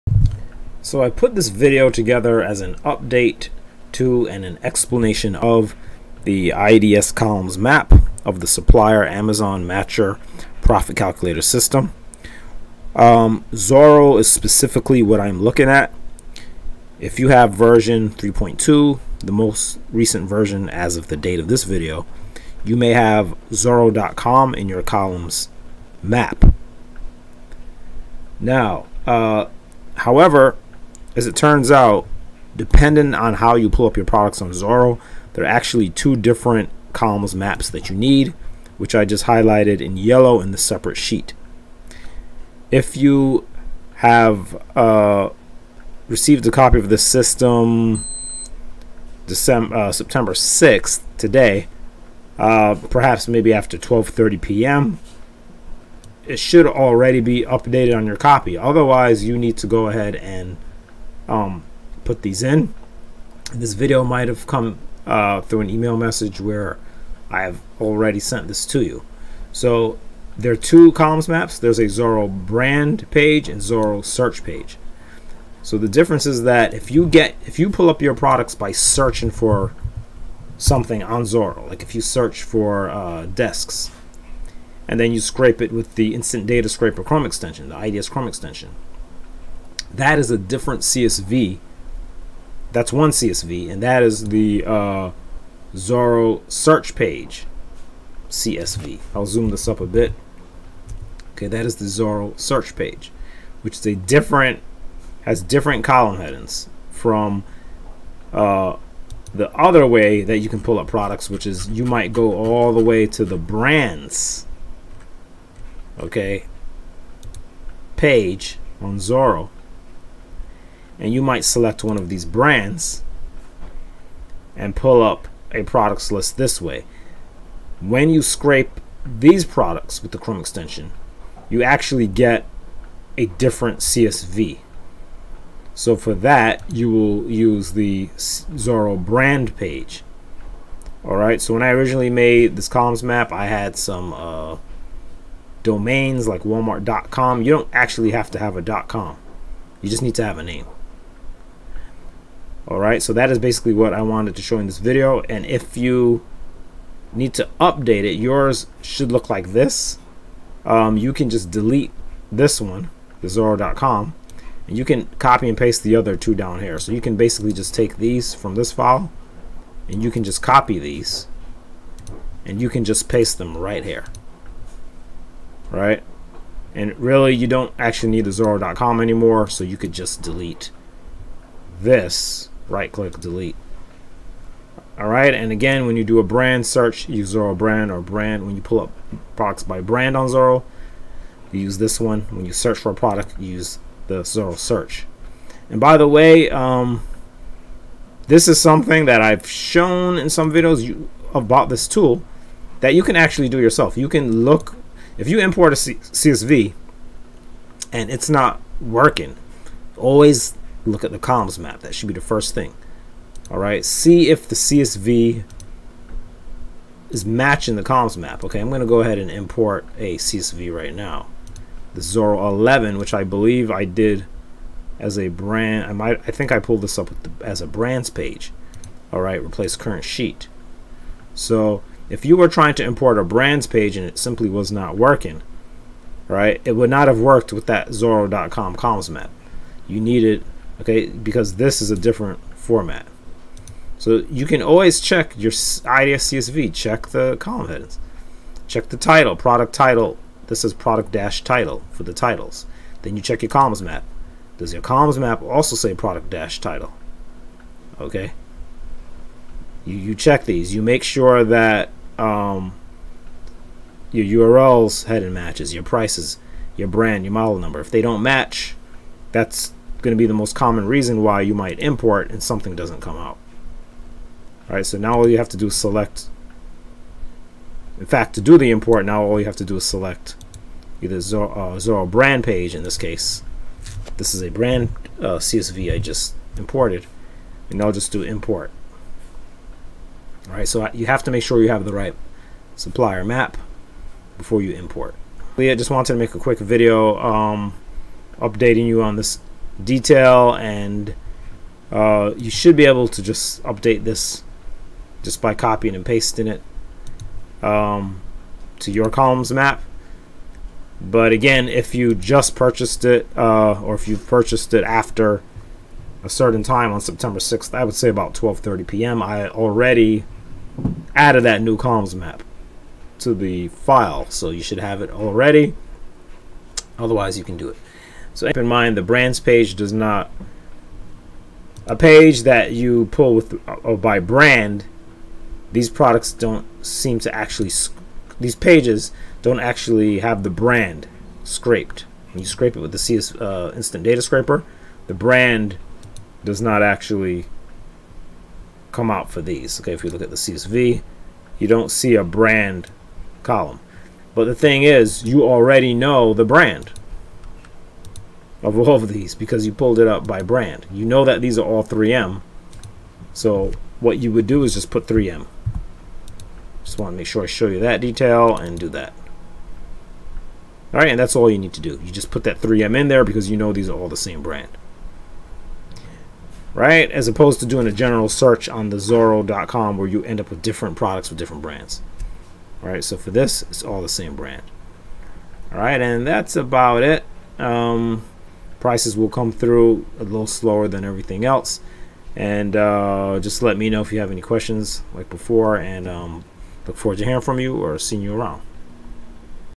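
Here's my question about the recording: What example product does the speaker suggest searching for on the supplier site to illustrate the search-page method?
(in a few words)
Desks.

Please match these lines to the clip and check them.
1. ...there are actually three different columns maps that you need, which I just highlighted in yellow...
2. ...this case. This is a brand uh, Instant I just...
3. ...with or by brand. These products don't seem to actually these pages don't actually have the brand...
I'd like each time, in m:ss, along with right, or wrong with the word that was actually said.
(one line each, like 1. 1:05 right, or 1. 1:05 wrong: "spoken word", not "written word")
1. 0:35 wrong: "two", not "three"
2. 4:42 wrong: "CSV", not "Instant"
3. 5:33 right.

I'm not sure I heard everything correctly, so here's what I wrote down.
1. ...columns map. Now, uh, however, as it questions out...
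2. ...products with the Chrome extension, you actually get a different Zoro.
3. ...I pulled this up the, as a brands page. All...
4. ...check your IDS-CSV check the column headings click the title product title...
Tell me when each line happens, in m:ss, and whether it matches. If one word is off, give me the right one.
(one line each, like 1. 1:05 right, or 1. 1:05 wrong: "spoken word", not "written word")
1. 0:24 wrong: "turns", not "questions"
2. 2:09 wrong: "CSV", not "Zoro"
3. 3:46 right
4. 4:04 wrong: "check", not "click".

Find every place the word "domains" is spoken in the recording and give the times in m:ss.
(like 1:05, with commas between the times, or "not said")
2:25.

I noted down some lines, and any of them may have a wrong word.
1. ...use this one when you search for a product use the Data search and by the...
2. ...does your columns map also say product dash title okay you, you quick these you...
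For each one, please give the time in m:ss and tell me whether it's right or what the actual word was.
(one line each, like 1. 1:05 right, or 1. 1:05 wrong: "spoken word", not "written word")
1. 3:11 wrong: "Zoro", not "Data"
2. 4:14 wrong: "check", not "quick".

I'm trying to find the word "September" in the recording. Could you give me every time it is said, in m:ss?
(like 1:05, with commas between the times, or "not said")
0:49, 5:17.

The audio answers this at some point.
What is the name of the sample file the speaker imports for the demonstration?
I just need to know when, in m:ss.
3:41.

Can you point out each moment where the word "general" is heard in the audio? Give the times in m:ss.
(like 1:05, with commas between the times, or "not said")
6:17.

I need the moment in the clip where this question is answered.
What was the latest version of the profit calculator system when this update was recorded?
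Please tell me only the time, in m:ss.
0:17.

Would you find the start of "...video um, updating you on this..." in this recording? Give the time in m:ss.
4:56.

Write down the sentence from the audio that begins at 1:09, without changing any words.
So there are two columns maps.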